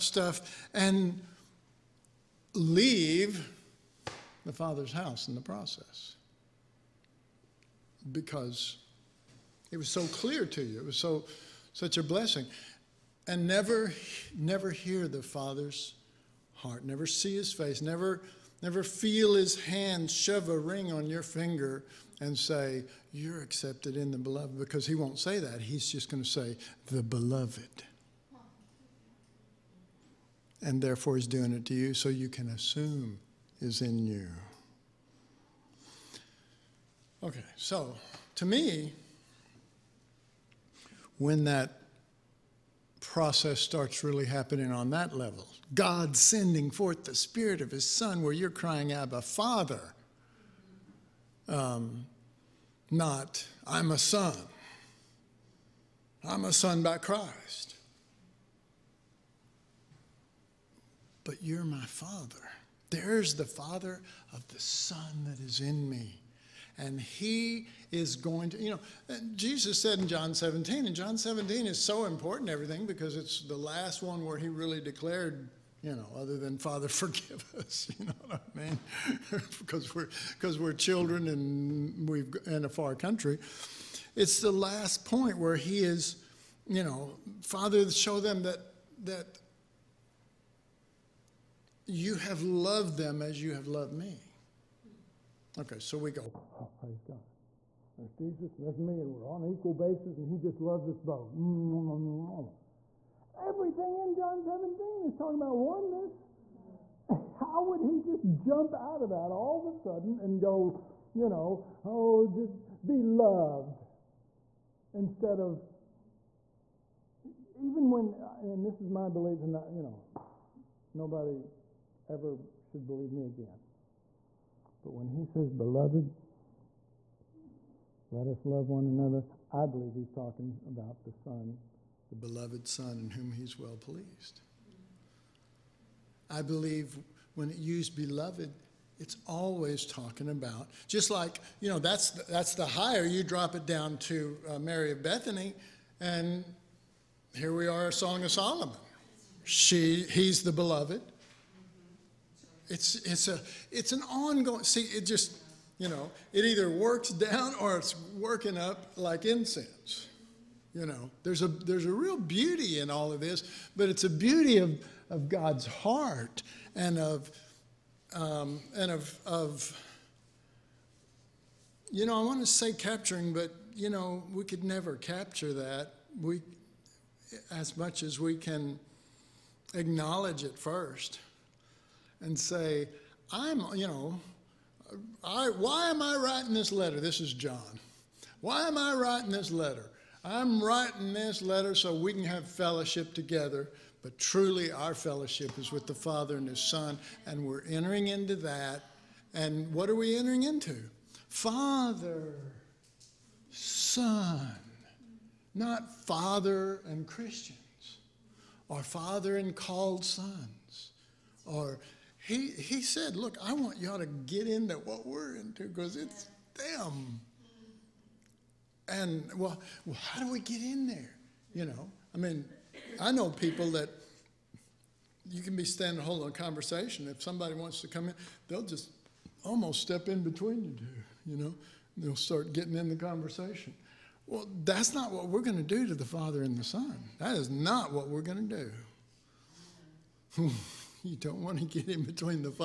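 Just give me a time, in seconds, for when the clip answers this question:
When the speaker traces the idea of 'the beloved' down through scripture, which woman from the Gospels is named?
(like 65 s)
144 s.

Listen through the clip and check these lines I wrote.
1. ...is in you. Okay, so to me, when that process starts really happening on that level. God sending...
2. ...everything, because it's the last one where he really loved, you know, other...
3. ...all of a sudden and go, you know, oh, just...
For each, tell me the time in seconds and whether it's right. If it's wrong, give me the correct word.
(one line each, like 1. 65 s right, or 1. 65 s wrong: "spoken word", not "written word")
1. 33 s right
2. 72 s wrong: "declared", not "loved"
3. 109 s right.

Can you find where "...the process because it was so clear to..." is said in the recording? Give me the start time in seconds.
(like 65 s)
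5 s.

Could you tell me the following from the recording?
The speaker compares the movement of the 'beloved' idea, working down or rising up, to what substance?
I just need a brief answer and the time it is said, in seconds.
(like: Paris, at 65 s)
Incense, at 159 s.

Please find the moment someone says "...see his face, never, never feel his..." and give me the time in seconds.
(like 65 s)
17 s.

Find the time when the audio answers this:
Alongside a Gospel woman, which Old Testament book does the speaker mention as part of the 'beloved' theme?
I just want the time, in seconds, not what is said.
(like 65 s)
147 s.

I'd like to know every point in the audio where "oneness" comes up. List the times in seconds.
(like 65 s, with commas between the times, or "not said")
105 s.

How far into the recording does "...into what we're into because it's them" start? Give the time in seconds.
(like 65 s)
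214 s.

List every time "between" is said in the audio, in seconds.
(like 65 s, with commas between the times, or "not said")
230 s, 242 s.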